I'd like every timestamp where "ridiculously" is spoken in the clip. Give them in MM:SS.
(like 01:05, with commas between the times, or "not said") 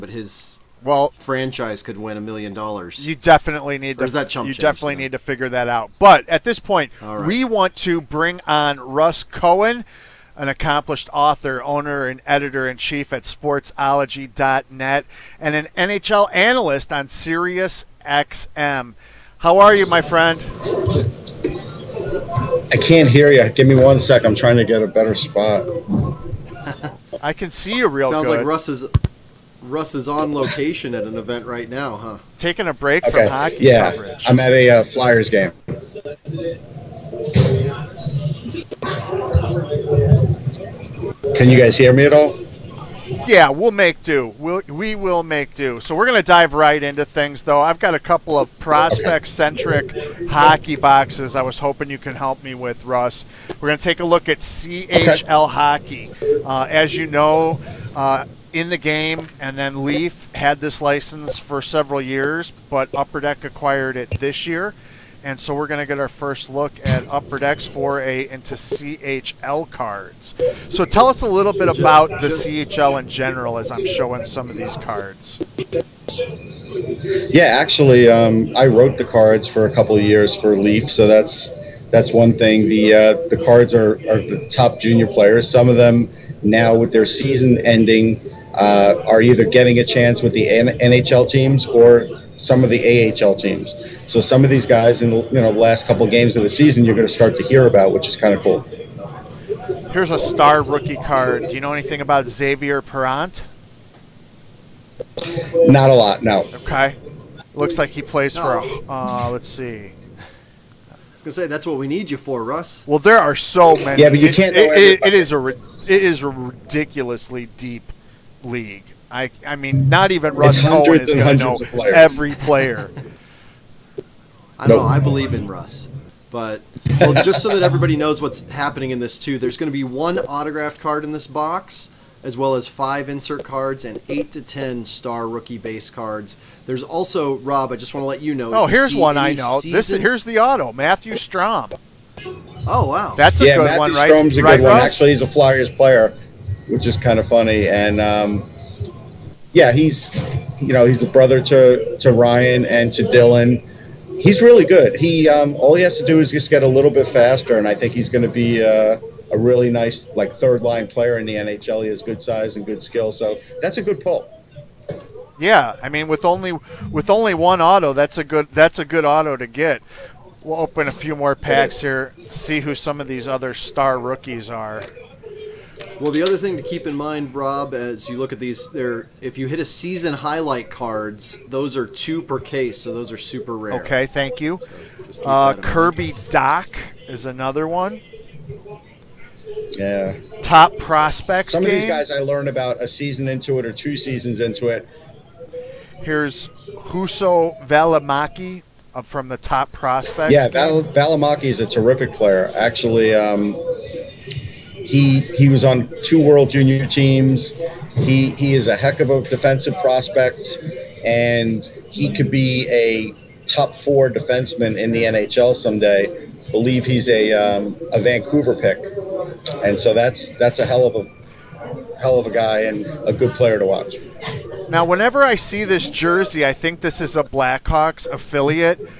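01:56.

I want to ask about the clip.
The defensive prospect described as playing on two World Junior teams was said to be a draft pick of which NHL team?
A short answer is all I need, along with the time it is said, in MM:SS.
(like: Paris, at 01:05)
Vancouver, at 03:37.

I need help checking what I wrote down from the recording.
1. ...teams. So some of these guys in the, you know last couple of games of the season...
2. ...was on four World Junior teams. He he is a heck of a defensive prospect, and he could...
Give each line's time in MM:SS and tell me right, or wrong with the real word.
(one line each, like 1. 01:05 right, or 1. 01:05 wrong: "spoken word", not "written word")
1. 01:33 right
2. 03:25 wrong: "two", not "four".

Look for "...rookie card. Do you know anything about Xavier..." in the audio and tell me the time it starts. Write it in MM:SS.
01:40.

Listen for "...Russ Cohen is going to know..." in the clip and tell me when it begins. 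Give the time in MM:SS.
02:00.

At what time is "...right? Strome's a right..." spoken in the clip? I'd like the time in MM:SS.
02:23.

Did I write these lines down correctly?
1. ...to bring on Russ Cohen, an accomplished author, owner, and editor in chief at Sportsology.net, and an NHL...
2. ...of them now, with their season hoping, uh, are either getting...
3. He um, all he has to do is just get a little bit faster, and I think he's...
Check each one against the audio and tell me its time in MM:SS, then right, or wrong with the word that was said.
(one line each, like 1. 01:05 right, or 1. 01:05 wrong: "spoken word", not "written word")
1. 00:07 right
2. 01:25 wrong: "ending", not "hoping"
3. 02:34 right.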